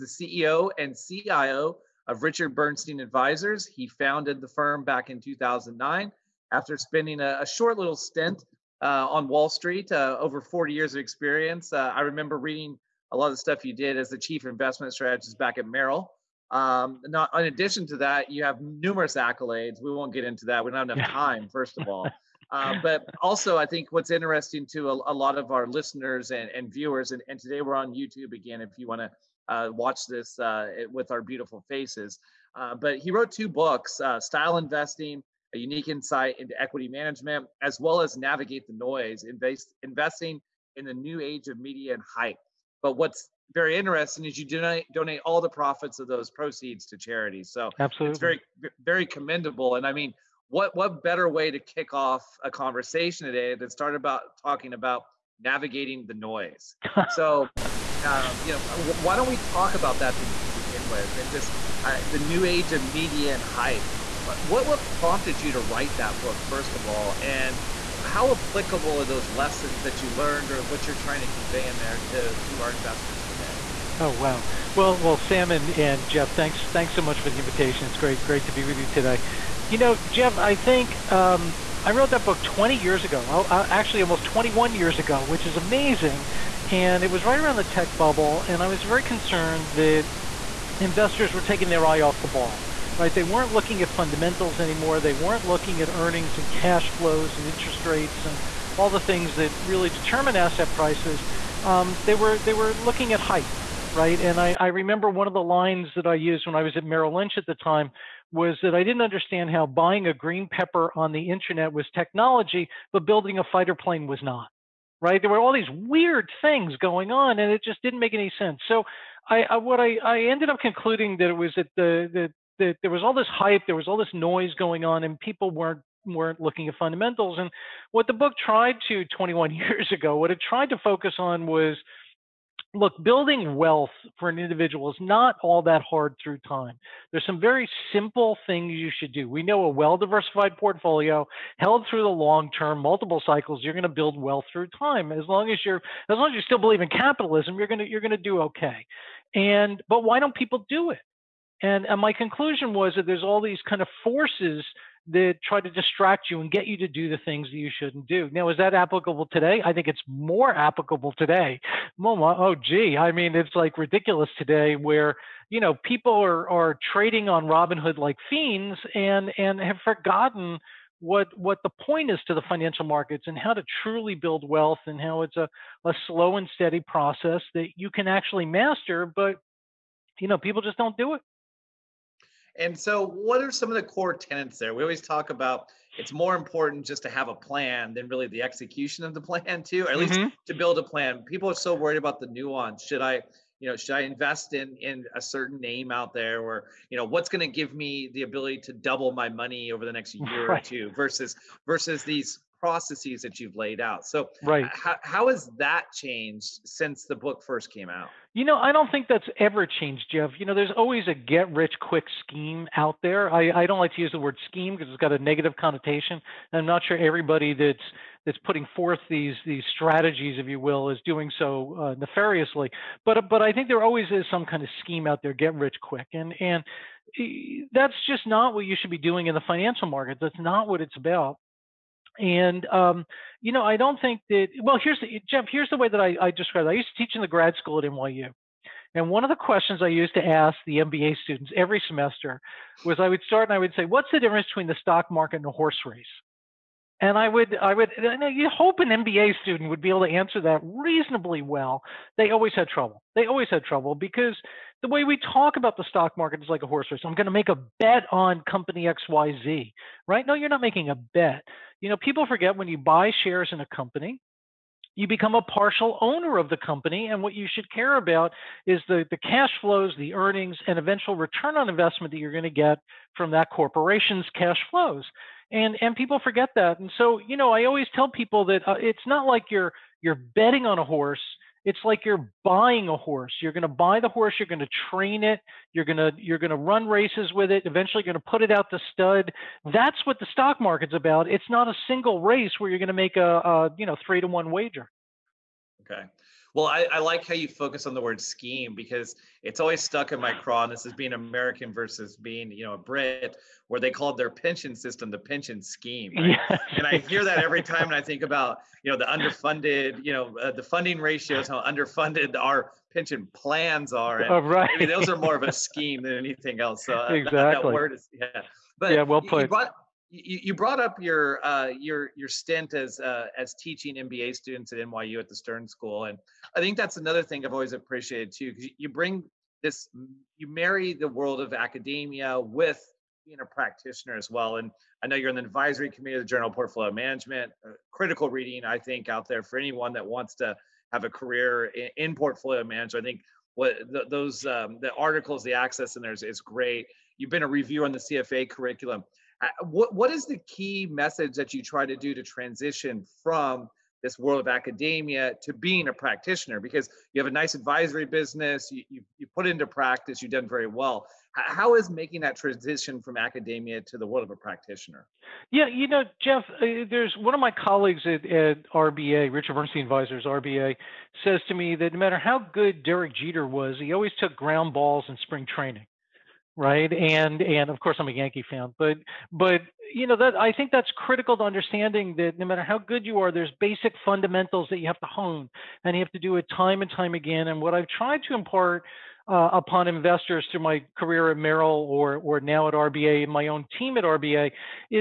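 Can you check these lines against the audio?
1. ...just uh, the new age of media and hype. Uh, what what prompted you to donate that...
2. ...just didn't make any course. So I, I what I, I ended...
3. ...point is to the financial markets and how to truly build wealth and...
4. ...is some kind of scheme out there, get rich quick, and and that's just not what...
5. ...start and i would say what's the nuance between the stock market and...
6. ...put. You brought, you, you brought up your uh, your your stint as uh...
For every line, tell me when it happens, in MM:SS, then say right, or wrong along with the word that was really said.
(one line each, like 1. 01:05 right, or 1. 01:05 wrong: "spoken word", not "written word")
1. 01:01 wrong: "write", not "donate"
2. 01:57 wrong: "sense", not "course"
3. 02:51 right
4. 03:44 right
5. 04:03 wrong: "difference", not "nuance"
6. 05:19 right.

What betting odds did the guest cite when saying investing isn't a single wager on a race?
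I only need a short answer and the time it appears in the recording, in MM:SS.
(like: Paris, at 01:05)
3 to 1, at 04:54.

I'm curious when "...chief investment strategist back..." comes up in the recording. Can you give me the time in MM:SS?
00:14.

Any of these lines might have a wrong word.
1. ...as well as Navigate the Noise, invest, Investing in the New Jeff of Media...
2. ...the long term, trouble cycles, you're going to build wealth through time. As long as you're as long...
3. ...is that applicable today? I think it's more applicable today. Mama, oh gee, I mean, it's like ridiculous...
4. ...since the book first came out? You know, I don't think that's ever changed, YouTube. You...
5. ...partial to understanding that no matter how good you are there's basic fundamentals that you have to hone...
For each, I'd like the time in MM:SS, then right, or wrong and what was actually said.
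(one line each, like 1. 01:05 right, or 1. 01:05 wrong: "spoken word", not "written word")
1. 00:37 wrong: "Age", not "Jeff"
2. 02:22 wrong: "multiple", not "trouble"
3. 02:38 right
4. 03:26 wrong: "Jeff", not "YouTube"
5. 06:20 wrong: "critical", not "partial".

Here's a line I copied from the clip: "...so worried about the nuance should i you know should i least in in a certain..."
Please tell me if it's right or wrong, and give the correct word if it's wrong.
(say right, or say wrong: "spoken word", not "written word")
wrong: "invest", not "least".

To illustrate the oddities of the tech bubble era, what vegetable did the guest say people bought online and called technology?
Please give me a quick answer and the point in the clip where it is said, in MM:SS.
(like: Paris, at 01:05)
green pepper, at 01:50.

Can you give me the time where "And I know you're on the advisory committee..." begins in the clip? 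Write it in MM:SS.
05:34.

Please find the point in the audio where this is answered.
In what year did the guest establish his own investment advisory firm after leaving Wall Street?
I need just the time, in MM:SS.
00:05.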